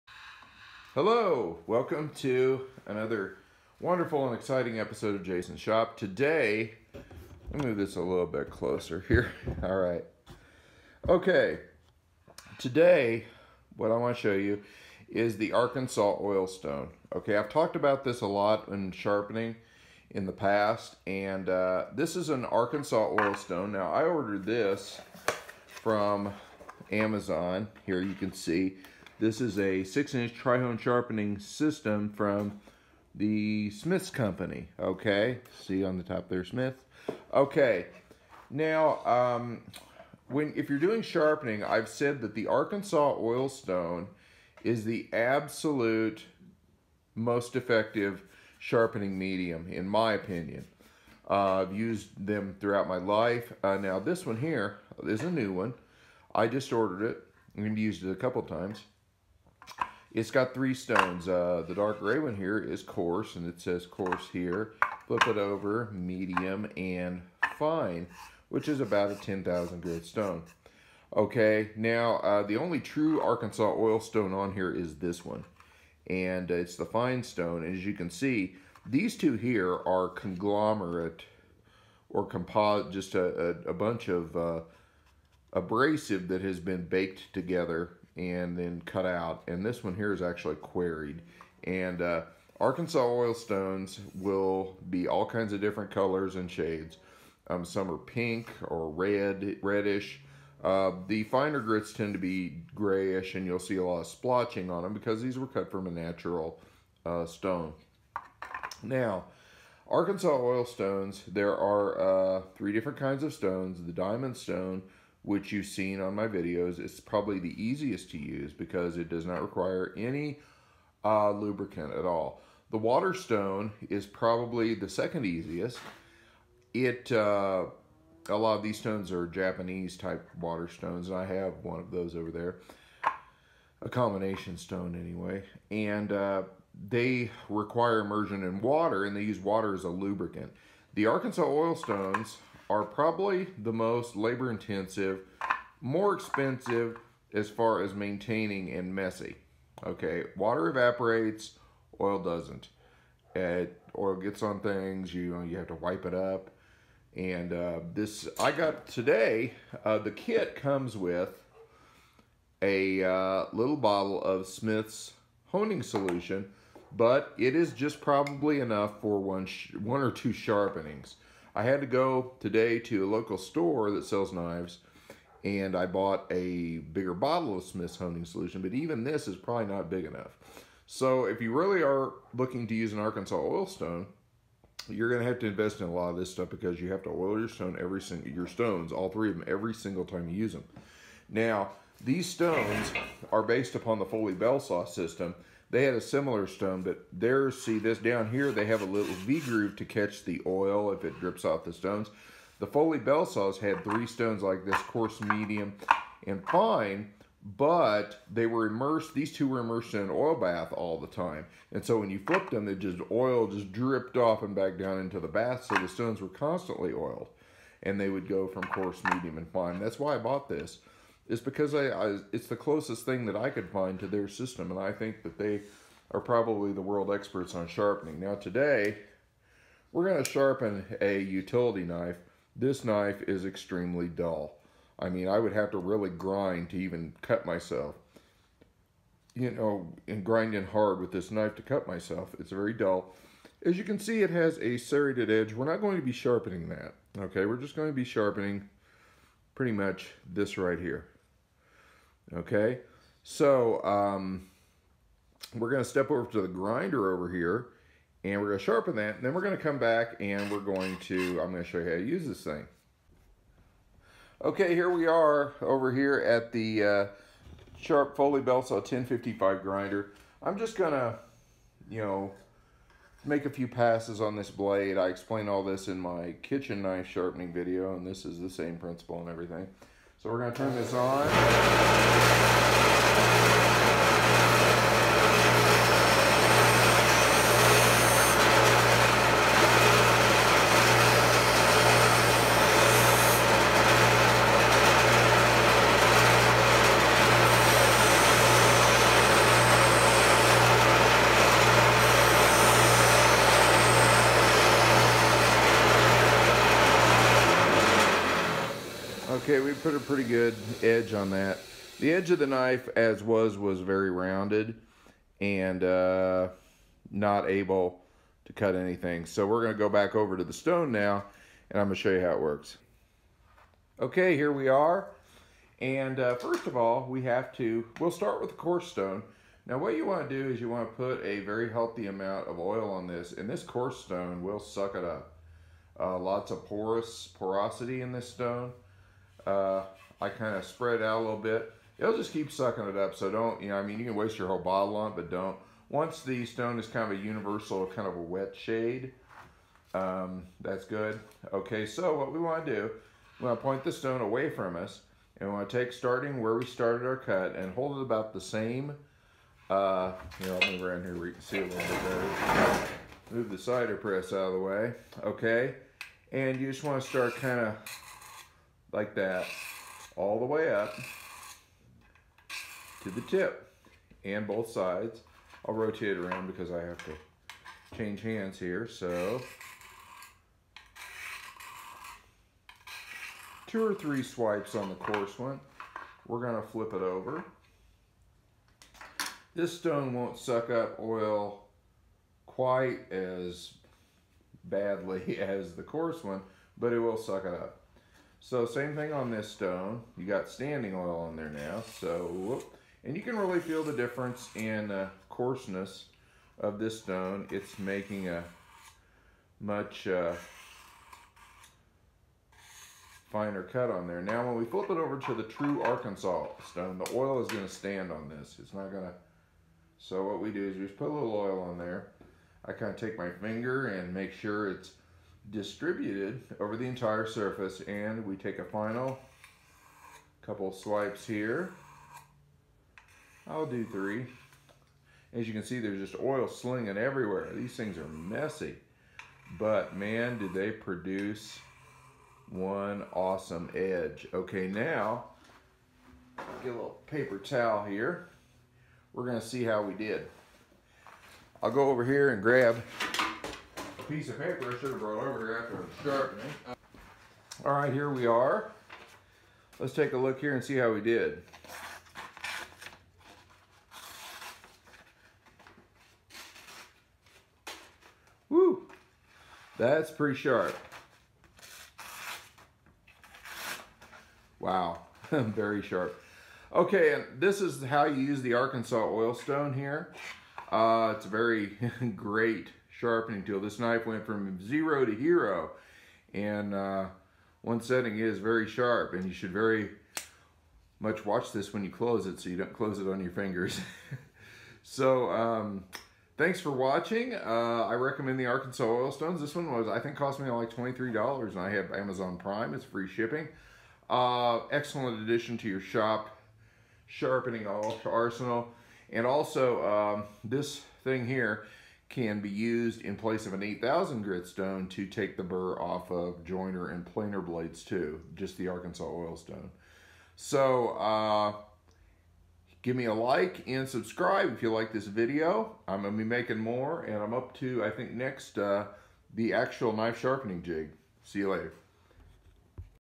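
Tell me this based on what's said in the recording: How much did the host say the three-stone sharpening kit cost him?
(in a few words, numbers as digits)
$23.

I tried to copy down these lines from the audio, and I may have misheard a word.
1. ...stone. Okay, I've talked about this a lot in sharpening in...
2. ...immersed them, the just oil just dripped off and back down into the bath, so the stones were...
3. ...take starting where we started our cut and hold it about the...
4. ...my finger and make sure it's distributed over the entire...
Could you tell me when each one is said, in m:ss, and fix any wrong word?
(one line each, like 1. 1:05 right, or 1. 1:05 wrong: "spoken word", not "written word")
1. 0:16 right
2. 3:32 wrong: "flipped", not "immersed"
3. 5:55 right
4. 7:03 right.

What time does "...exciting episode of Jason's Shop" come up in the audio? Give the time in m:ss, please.
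0:04.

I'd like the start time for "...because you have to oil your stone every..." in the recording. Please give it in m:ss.
3:06.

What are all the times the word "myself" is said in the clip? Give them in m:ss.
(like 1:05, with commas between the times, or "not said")
3:57, 4:01.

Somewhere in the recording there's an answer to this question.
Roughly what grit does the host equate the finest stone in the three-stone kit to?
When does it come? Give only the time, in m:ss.
1:09.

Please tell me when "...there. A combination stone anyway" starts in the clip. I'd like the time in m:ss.
2:12.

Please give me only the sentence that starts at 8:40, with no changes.
So uh, give me a like and subscribe if you like this video.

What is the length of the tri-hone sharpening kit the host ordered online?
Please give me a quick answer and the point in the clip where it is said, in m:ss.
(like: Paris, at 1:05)
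6 inch, at 0:29.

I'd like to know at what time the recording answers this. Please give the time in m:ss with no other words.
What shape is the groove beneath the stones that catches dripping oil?
3:19.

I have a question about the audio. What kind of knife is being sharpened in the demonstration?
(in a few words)
Utility knife.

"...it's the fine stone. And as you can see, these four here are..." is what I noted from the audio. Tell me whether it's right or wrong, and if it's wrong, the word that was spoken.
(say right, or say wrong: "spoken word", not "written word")
wrong: "two", not "four".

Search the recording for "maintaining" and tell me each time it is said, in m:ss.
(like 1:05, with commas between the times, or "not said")
2:27.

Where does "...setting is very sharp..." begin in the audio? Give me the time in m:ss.
8:07.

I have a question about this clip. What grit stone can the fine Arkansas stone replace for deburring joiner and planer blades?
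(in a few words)
8000 grit.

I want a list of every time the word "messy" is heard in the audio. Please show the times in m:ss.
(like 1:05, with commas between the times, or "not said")
2:28, 7:18.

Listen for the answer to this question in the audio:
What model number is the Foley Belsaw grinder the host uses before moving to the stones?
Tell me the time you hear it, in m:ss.
4:28.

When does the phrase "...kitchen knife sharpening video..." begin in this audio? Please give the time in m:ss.
4:36.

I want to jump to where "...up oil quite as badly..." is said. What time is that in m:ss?
6:30.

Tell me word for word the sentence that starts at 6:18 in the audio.
So two or three swipes on the coarse one.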